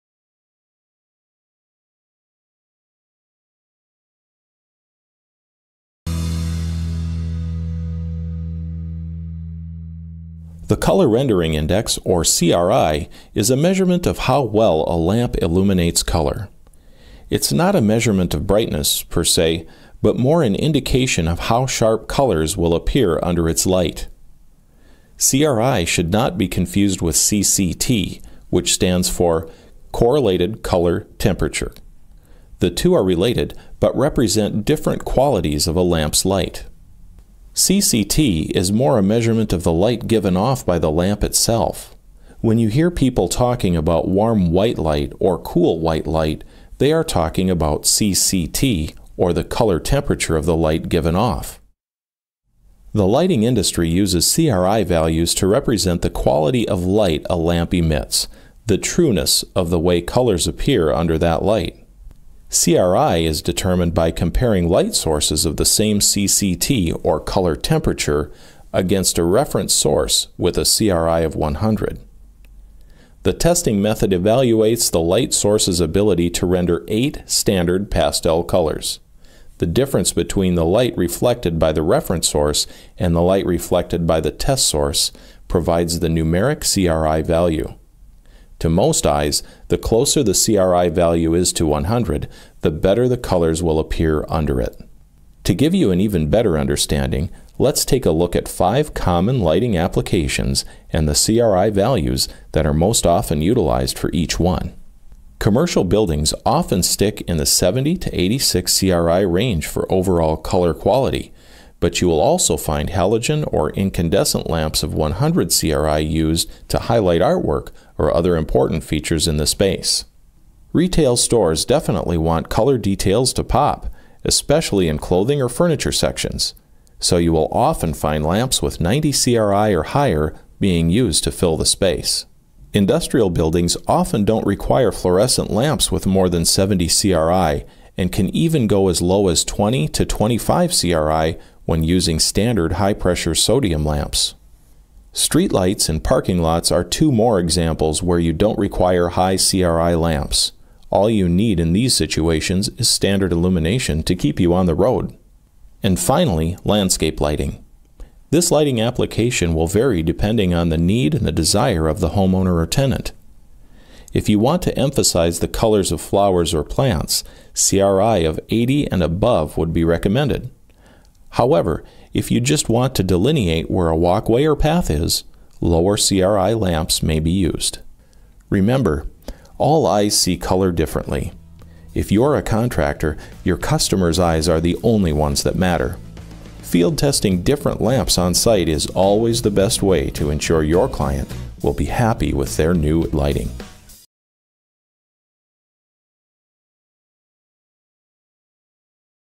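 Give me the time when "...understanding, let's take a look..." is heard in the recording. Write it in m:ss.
1:36.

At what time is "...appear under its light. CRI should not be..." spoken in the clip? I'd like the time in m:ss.
0:22.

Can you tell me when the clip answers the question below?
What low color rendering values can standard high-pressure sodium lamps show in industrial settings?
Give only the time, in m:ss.
2:19.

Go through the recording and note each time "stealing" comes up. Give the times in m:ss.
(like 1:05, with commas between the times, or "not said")
not said.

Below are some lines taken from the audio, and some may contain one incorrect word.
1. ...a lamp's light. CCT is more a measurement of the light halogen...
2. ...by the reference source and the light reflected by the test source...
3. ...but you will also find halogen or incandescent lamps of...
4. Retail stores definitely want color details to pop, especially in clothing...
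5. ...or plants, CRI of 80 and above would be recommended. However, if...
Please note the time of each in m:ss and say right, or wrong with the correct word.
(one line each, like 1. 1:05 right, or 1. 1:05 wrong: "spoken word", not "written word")
1. 0:35 wrong: "given", not "halogen"
2. 1:21 right
3. 1:51 right
4. 2:00 right
5. 2:46 right.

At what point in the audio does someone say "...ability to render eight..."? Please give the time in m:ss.
1:15.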